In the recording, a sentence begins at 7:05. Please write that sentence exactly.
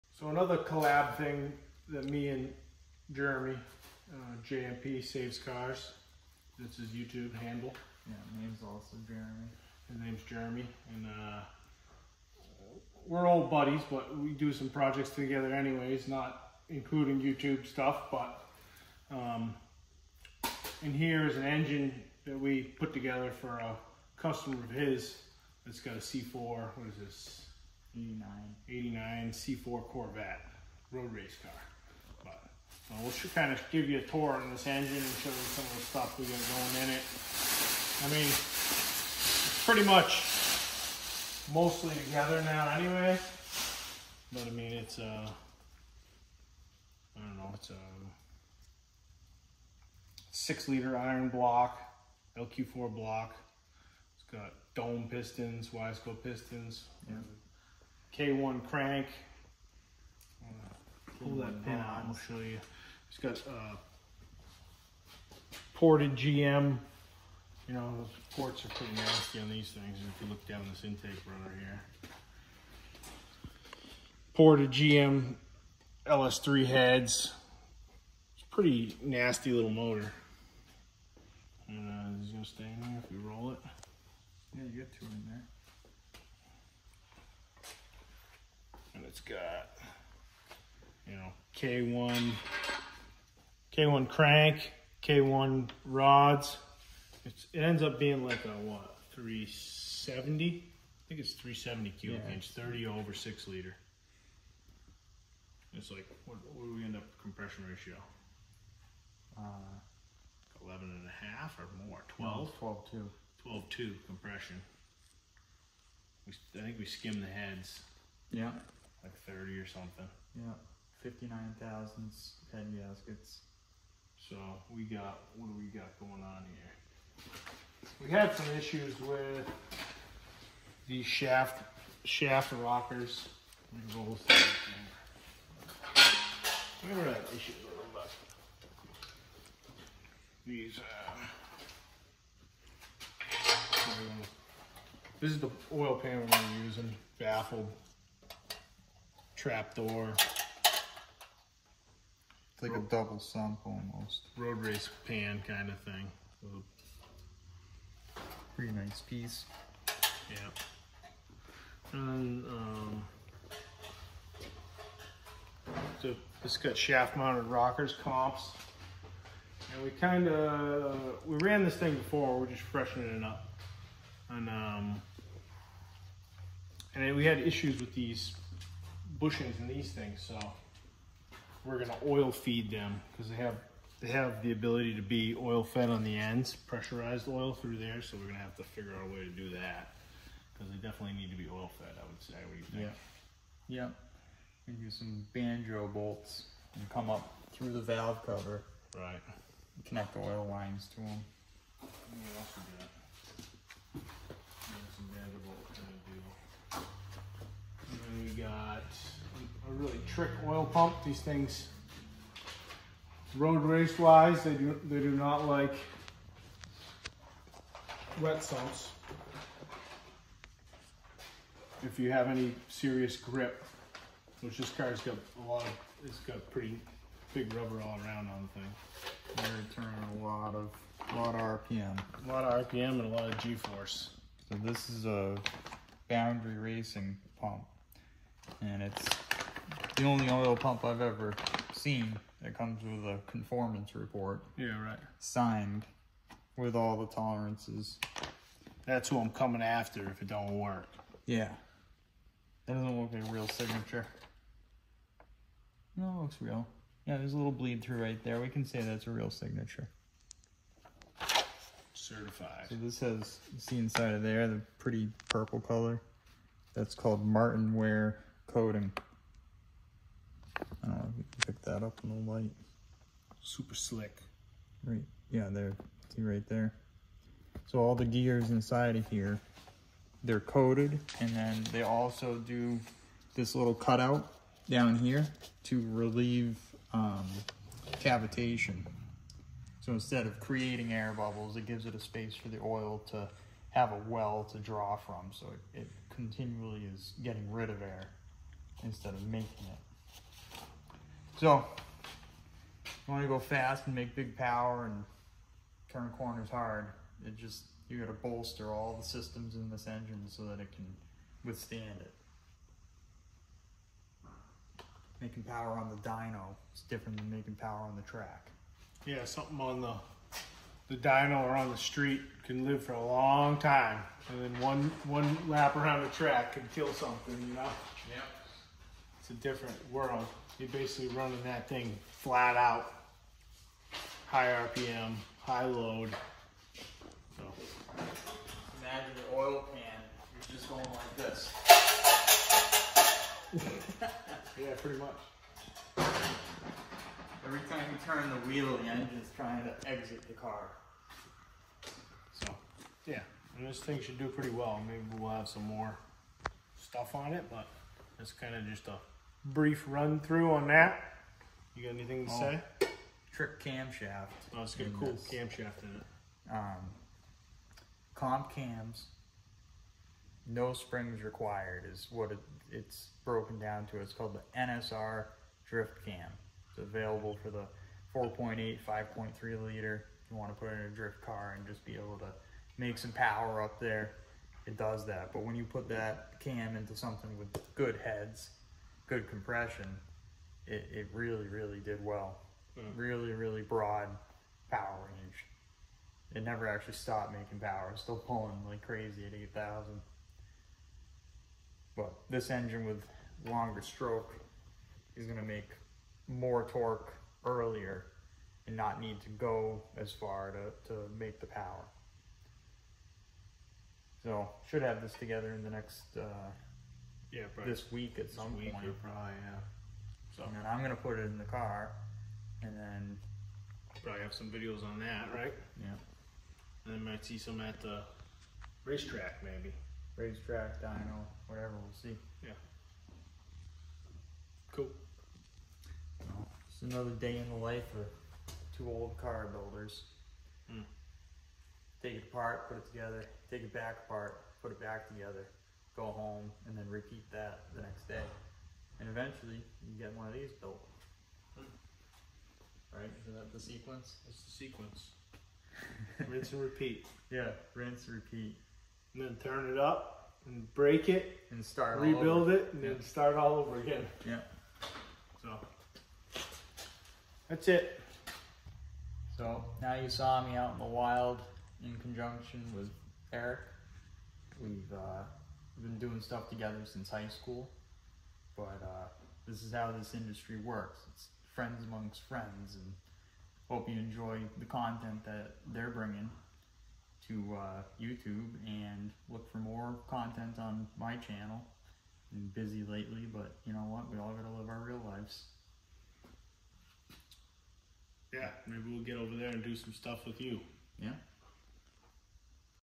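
yeah, And then might see some at the racetrack maybe.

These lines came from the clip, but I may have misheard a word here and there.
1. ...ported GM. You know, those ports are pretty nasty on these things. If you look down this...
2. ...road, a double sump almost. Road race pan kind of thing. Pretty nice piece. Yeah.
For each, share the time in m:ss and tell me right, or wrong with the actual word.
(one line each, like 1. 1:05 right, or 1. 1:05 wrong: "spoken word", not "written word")
1. 1:05 right
2. 2:32 right.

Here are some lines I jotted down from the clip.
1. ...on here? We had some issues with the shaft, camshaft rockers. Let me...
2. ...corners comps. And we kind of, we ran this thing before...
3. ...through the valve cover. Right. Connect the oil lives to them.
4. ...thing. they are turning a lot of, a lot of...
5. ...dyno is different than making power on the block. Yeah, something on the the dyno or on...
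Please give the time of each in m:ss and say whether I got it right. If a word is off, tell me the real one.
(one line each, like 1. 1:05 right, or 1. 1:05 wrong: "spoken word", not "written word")
1. 2:06 wrong: "shaft", not "camshaft"
2. 2:47 wrong: "rockers", not "corners"
3. 3:17 wrong: "lines", not "lives"
4. 3:48 right
5. 5:16 wrong: "track", not "block".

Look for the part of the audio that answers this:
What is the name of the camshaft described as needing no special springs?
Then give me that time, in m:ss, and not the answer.
6:14.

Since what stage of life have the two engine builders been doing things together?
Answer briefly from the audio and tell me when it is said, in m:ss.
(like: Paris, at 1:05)
high school, at 7:57.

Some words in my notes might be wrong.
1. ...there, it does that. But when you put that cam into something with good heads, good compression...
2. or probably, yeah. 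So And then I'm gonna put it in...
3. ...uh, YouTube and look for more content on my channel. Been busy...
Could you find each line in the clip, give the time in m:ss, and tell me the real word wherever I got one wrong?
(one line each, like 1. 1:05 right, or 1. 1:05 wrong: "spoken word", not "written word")
1. 6:23 right
2. 6:58 right
3. 8:07 right.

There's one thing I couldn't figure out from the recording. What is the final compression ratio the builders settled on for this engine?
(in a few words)
12.2.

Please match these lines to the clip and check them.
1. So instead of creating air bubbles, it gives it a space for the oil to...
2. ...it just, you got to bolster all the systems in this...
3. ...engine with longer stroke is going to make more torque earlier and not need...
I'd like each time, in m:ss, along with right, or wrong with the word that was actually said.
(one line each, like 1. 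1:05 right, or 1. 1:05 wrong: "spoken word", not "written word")
1. 4:49 right
2. 5:07 right
3. 6:42 right.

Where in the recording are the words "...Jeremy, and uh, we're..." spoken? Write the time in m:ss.
0:10.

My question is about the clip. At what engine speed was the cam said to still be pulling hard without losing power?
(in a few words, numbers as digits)
8,000.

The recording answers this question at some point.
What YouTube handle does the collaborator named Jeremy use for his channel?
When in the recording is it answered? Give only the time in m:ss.
0:04.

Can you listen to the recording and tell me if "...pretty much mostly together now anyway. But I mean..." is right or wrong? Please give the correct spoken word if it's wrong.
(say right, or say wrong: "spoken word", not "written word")
right.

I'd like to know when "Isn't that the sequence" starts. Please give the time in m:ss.
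7:33.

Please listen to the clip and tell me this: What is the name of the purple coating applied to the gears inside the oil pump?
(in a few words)
MartenWear.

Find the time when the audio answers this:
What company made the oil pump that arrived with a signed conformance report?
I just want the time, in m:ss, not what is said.
3:56.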